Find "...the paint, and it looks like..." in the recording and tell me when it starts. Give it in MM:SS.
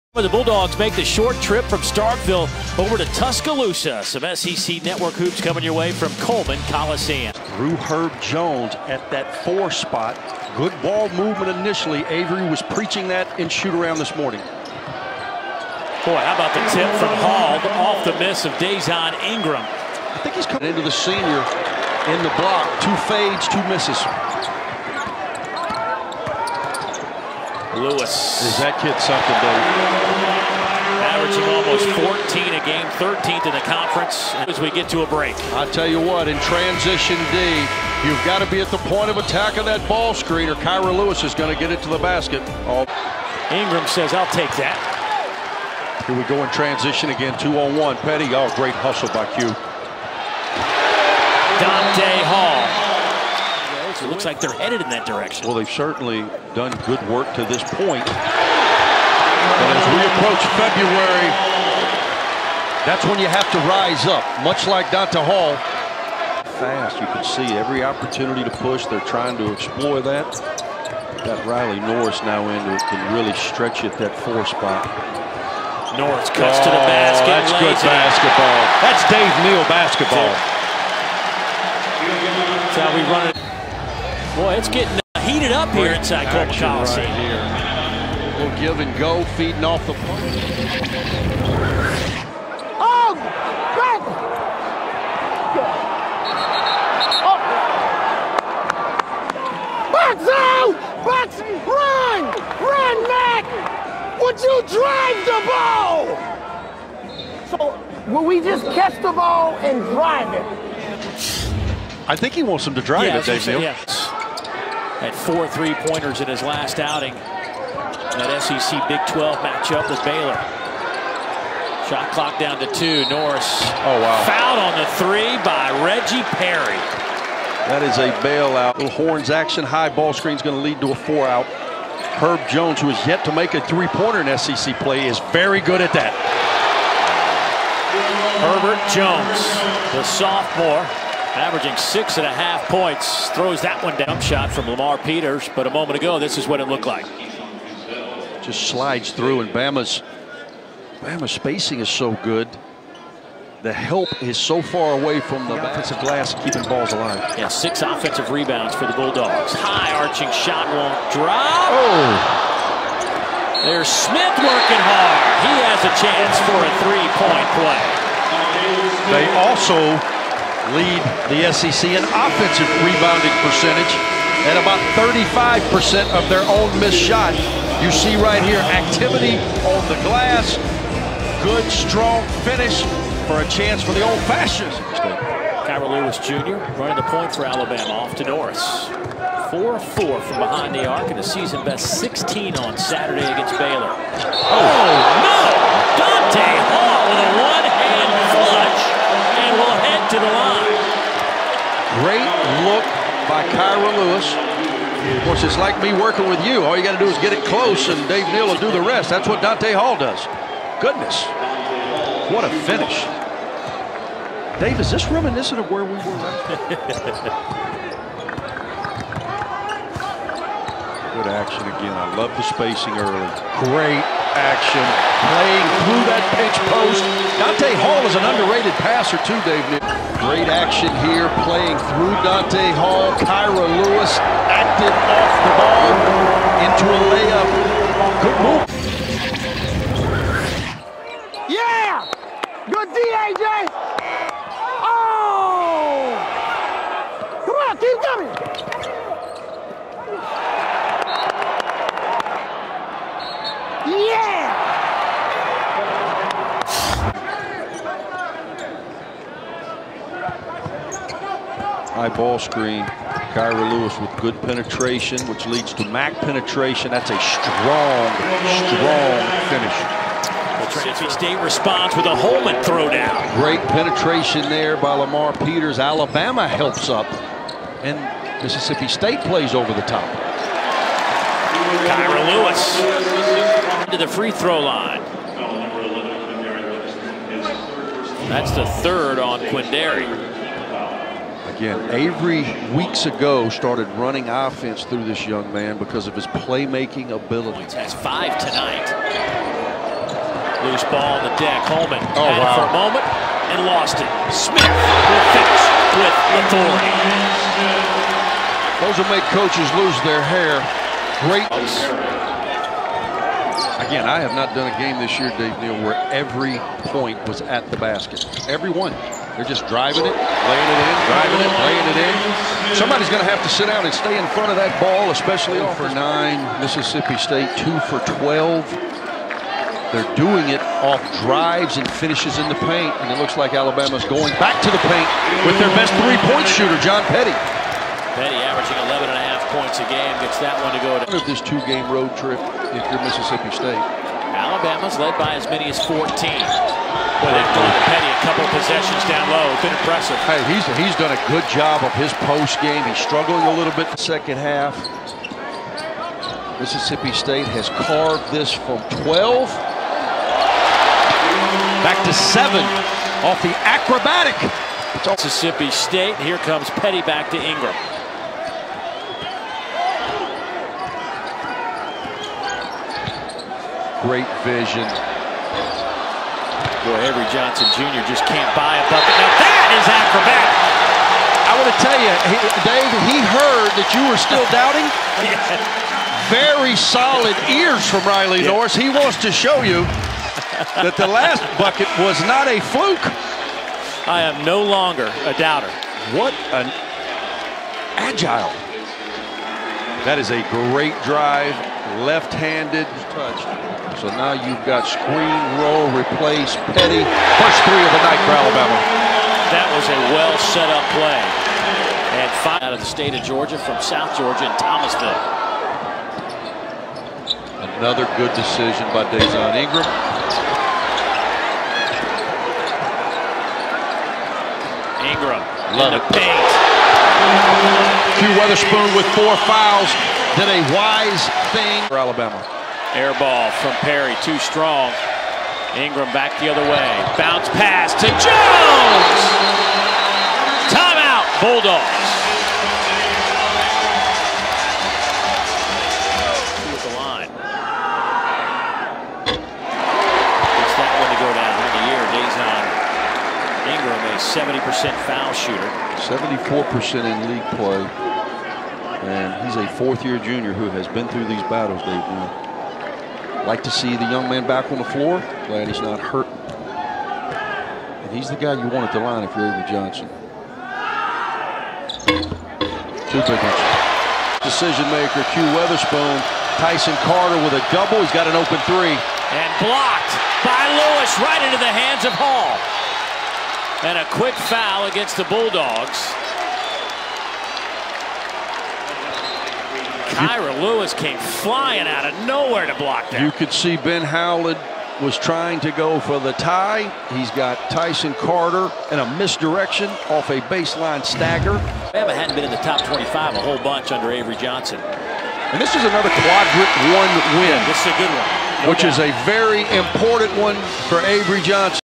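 05:32.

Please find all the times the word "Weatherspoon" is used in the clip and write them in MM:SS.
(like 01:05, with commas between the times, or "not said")
07:08, 07:55.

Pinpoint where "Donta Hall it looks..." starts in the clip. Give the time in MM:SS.
00:51.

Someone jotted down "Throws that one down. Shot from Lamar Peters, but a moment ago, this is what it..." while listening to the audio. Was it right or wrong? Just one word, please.
right.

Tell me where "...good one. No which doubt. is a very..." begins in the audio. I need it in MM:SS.
08:27.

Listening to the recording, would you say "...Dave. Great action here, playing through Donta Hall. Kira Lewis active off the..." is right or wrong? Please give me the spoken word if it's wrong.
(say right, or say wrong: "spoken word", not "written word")
right.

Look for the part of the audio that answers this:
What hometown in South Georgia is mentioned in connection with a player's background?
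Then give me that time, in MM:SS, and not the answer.
06:54.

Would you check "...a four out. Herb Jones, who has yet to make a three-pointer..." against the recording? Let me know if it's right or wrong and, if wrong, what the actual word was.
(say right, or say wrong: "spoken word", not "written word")
right.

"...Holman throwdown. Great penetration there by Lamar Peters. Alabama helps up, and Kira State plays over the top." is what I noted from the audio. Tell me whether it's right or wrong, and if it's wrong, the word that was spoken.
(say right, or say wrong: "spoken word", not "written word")
wrong: "Mississippi", not "Kira".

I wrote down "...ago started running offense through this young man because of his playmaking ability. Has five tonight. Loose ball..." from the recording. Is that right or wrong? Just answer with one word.
right.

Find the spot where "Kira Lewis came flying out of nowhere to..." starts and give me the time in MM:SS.
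08:10.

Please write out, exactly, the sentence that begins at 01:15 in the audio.
Norris cuts oh, to the oh, basket.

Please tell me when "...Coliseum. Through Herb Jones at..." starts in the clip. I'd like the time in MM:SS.
00:06.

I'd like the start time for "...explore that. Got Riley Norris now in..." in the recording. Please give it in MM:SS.
01:09.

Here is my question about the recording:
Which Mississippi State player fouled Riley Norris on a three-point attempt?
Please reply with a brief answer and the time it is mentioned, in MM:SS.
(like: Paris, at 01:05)
Reggie Perry, at 02:05.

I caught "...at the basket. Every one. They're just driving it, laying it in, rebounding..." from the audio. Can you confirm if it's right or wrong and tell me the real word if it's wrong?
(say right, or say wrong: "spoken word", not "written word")
wrong: "driving", not "rebounding".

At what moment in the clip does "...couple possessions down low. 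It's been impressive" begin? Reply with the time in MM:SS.
05:48.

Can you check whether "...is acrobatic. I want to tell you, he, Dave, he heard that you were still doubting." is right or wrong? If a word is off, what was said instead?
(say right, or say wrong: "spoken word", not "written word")
right.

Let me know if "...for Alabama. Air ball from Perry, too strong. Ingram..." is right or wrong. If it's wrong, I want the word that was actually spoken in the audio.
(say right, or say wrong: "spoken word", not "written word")
right.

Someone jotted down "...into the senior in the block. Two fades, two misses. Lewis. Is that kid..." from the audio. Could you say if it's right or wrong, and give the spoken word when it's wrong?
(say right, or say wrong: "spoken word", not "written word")
right.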